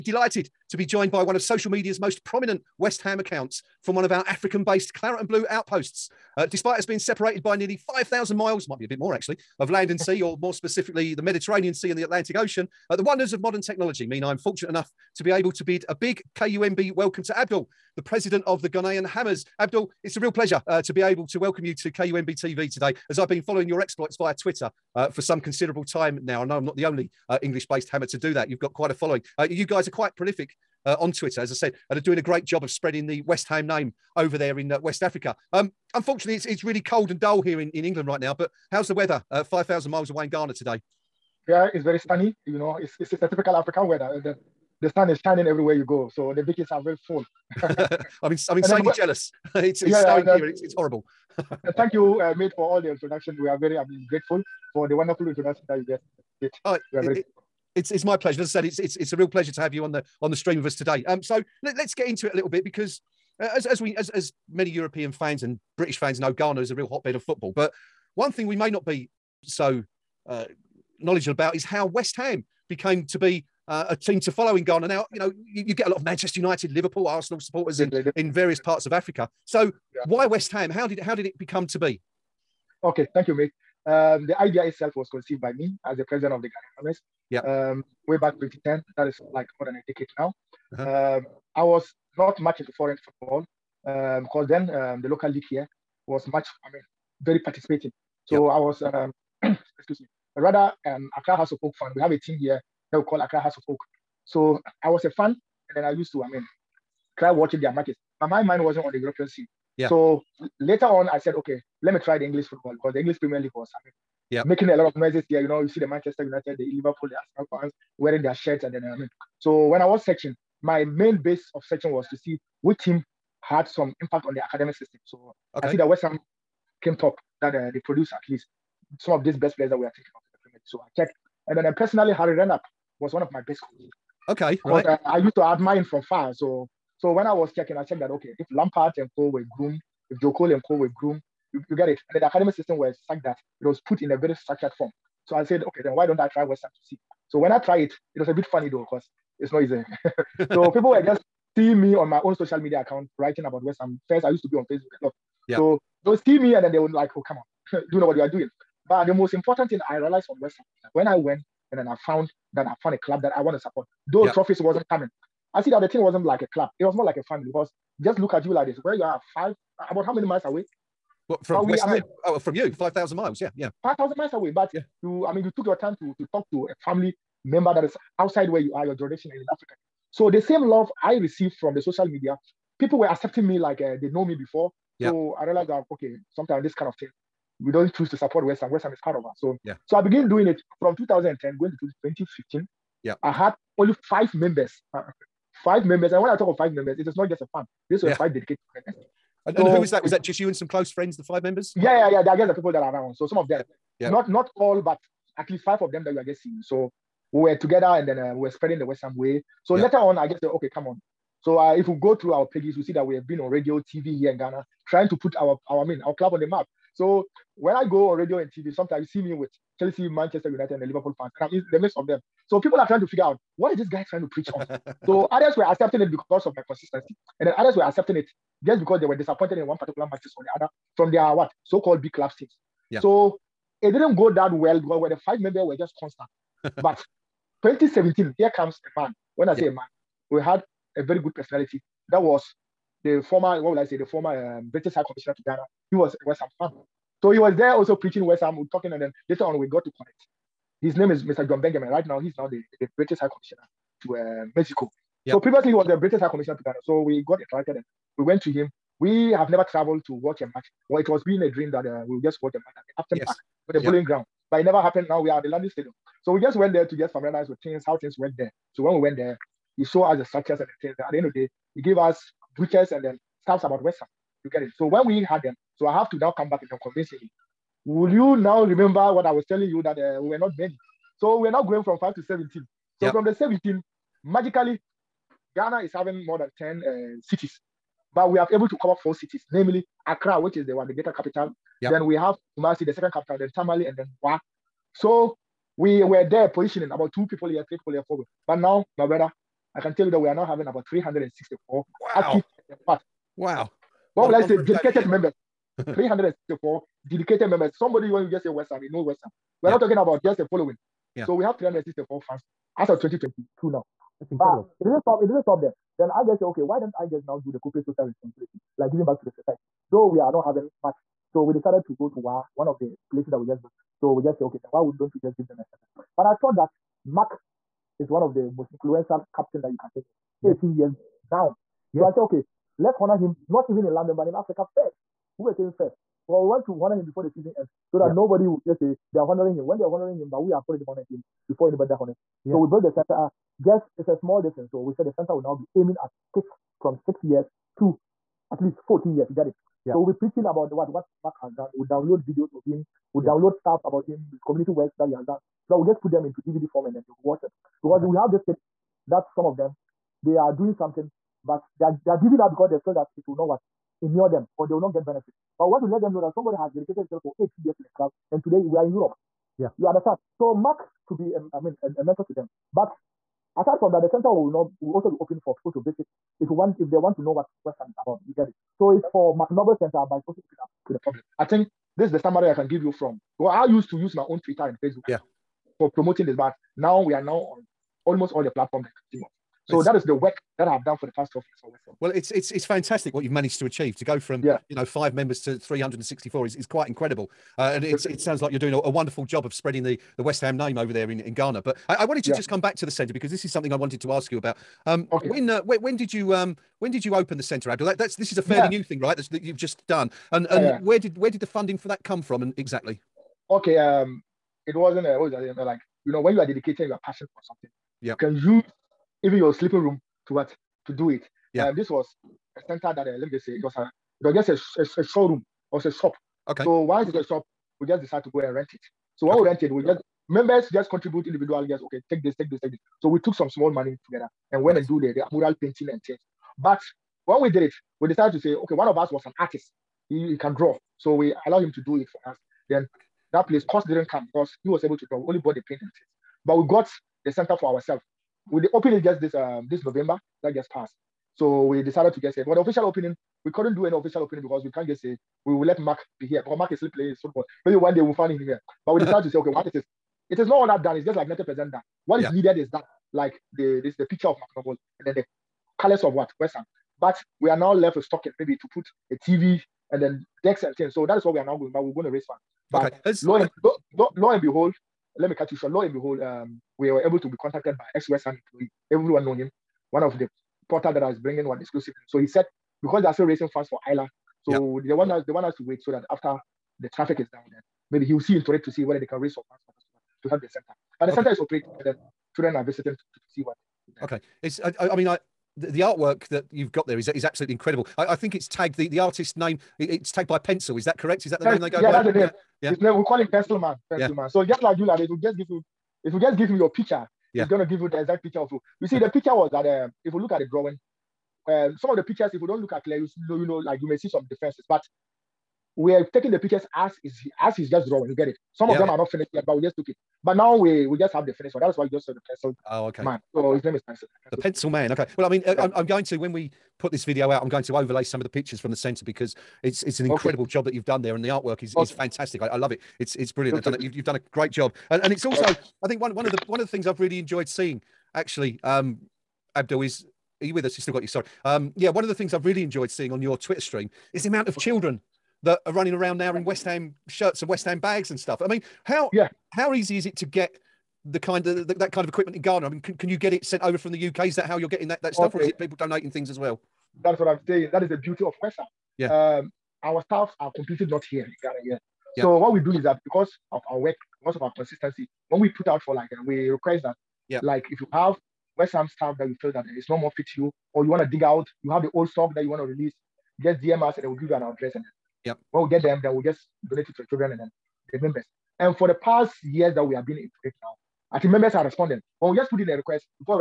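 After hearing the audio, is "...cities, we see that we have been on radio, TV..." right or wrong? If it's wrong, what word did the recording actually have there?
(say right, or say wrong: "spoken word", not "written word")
wrong: "pages", not "cities".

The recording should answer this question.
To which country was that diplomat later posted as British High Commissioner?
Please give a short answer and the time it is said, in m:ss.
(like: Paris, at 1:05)
Mexico, at 4:14.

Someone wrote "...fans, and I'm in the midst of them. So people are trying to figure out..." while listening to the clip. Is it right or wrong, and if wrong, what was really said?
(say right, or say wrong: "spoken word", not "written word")
right.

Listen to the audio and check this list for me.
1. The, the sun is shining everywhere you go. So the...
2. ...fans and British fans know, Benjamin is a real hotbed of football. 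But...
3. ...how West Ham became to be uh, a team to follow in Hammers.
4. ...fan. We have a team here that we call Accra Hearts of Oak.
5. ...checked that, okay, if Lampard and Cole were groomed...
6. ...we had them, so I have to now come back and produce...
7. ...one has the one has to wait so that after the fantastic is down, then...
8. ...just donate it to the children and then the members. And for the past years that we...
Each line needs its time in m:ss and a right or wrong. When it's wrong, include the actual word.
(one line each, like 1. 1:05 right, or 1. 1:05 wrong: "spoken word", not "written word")
1. 0:44 right
2. 1:05 wrong: "Ghana", not "Benjamin"
3. 1:11 wrong: "Ghana", not "Hammers"
4. 1:41 right
5. 2:17 right
6. 4:35 wrong: "convince", not "produce"
7. 8:04 wrong: "traffic", not "fantastic"
8. 9:36 right.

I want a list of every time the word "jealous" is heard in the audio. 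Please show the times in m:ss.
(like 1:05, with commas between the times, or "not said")
0:48.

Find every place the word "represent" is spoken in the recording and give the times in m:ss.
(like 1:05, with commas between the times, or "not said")
not said.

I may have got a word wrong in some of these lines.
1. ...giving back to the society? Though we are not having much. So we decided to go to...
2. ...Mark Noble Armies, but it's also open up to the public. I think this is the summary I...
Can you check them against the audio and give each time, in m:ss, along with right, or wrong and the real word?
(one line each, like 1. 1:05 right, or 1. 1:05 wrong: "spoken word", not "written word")
1. 5:18 right
2. 6:19 wrong: "Center", not "Armies".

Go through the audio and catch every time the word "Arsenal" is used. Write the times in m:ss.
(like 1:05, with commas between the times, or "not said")
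1:17, 1:57.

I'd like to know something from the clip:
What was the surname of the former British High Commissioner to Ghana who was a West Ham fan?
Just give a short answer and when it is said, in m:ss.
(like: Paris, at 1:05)
Benjamin, at 4:11.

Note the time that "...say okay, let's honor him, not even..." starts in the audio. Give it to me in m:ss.
5:32.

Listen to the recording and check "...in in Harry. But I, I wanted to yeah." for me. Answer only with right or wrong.
wrong.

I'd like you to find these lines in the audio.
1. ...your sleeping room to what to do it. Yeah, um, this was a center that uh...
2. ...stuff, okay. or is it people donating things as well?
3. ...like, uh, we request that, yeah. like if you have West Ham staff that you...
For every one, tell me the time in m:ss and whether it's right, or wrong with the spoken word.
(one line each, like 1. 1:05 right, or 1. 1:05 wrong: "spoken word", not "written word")
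1. 6:59 right
2. 9:15 right
3. 9:25 right.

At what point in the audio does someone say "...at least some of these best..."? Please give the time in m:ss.
2:08.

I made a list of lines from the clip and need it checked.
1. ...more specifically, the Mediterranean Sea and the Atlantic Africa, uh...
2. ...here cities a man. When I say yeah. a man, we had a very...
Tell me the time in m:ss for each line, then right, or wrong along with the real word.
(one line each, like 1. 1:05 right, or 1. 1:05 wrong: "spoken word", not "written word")
1. 0:10 wrong: "Ocean", not "Africa"
2. 3:58 wrong: "comes", not "cities".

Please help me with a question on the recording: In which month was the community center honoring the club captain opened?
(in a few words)
November.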